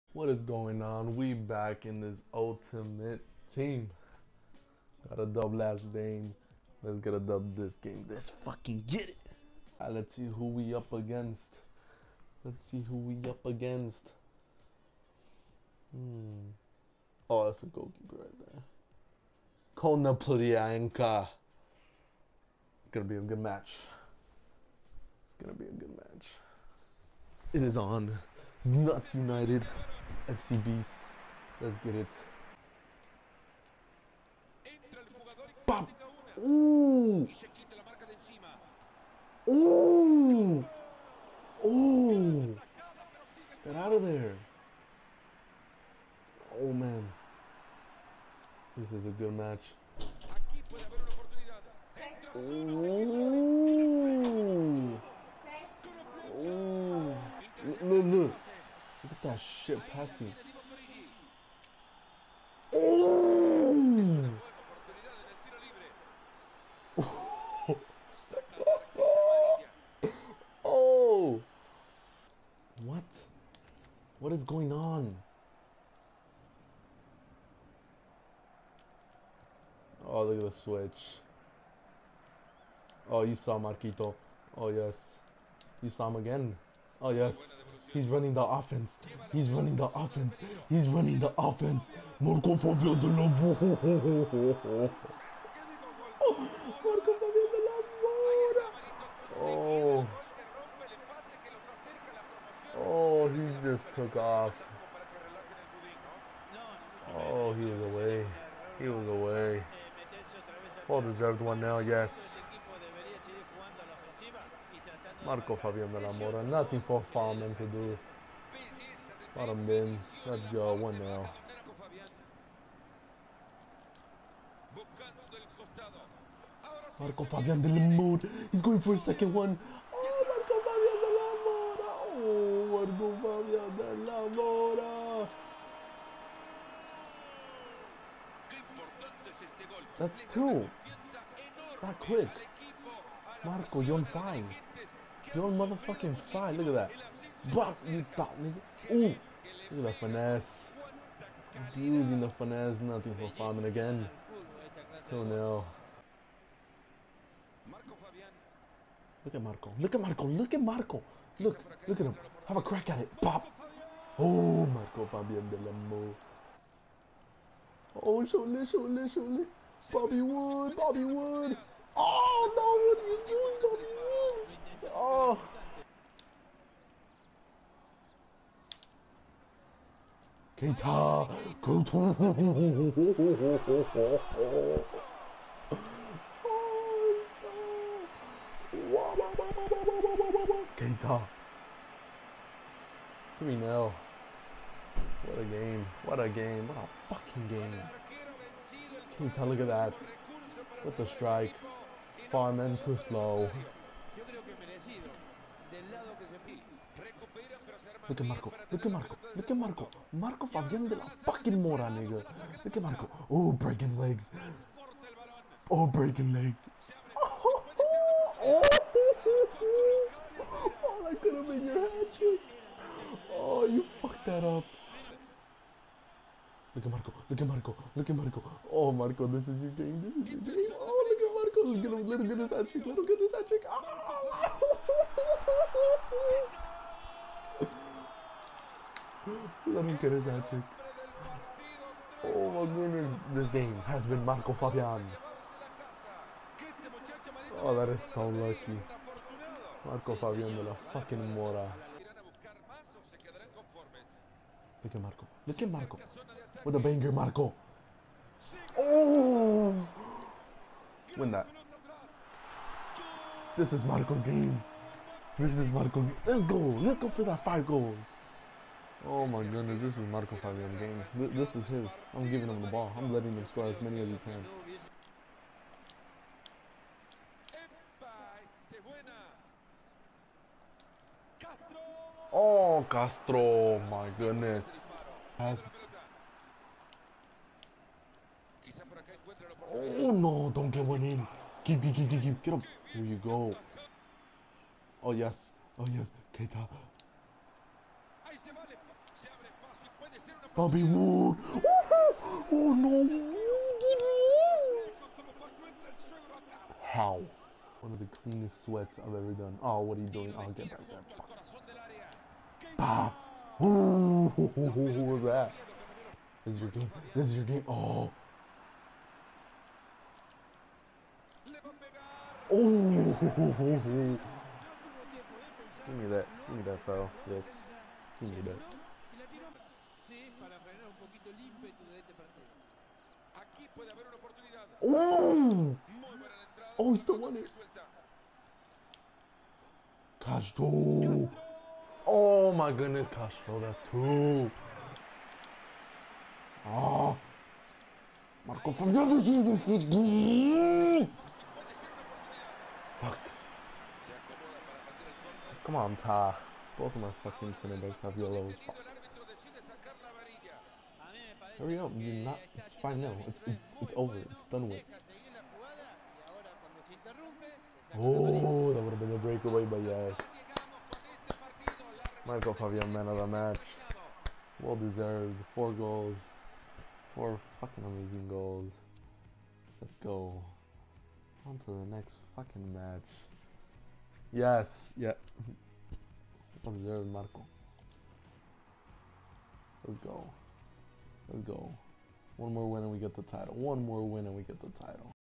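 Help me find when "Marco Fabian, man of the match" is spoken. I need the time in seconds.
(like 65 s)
372 s.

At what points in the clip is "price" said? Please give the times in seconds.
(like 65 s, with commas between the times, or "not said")
not said.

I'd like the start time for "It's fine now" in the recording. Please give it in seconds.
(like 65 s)
362 s.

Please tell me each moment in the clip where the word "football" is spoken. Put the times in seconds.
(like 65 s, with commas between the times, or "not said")
349 s.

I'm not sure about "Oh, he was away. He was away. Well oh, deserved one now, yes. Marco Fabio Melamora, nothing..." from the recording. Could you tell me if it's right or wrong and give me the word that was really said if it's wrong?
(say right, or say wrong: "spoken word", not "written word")
right.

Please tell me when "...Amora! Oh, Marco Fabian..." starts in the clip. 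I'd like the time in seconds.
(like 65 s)
131 s.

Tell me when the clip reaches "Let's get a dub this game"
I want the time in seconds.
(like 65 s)
6 s.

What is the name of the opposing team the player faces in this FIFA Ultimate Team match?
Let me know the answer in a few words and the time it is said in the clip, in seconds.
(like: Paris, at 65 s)
FC Beasts, at 30 s.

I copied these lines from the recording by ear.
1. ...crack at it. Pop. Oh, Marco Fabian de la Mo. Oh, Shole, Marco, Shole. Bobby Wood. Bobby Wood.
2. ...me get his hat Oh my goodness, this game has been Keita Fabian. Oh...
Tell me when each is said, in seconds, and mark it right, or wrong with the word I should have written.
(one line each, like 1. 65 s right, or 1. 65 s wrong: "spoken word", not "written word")
1. 162 s wrong: "Shole", not "Marco"
2. 239 s wrong: "Marco", not "Keita".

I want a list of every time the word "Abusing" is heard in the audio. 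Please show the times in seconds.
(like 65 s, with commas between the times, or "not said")
151 s.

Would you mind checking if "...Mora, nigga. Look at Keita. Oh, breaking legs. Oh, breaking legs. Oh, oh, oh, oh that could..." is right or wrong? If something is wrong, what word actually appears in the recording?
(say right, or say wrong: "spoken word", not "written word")
wrong: "Marco", not "Keita".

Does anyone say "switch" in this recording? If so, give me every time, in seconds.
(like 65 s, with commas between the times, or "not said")
80 s.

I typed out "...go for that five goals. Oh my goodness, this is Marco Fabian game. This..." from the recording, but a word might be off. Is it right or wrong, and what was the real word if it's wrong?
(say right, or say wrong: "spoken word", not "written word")
right.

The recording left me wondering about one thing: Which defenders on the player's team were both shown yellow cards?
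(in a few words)
center backs.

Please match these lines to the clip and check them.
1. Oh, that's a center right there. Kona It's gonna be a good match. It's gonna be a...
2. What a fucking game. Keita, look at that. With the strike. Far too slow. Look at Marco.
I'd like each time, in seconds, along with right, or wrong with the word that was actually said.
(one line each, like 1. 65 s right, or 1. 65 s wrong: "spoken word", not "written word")
1. 17 s wrong: "goalkeeper", not "center"
2. 196 s right.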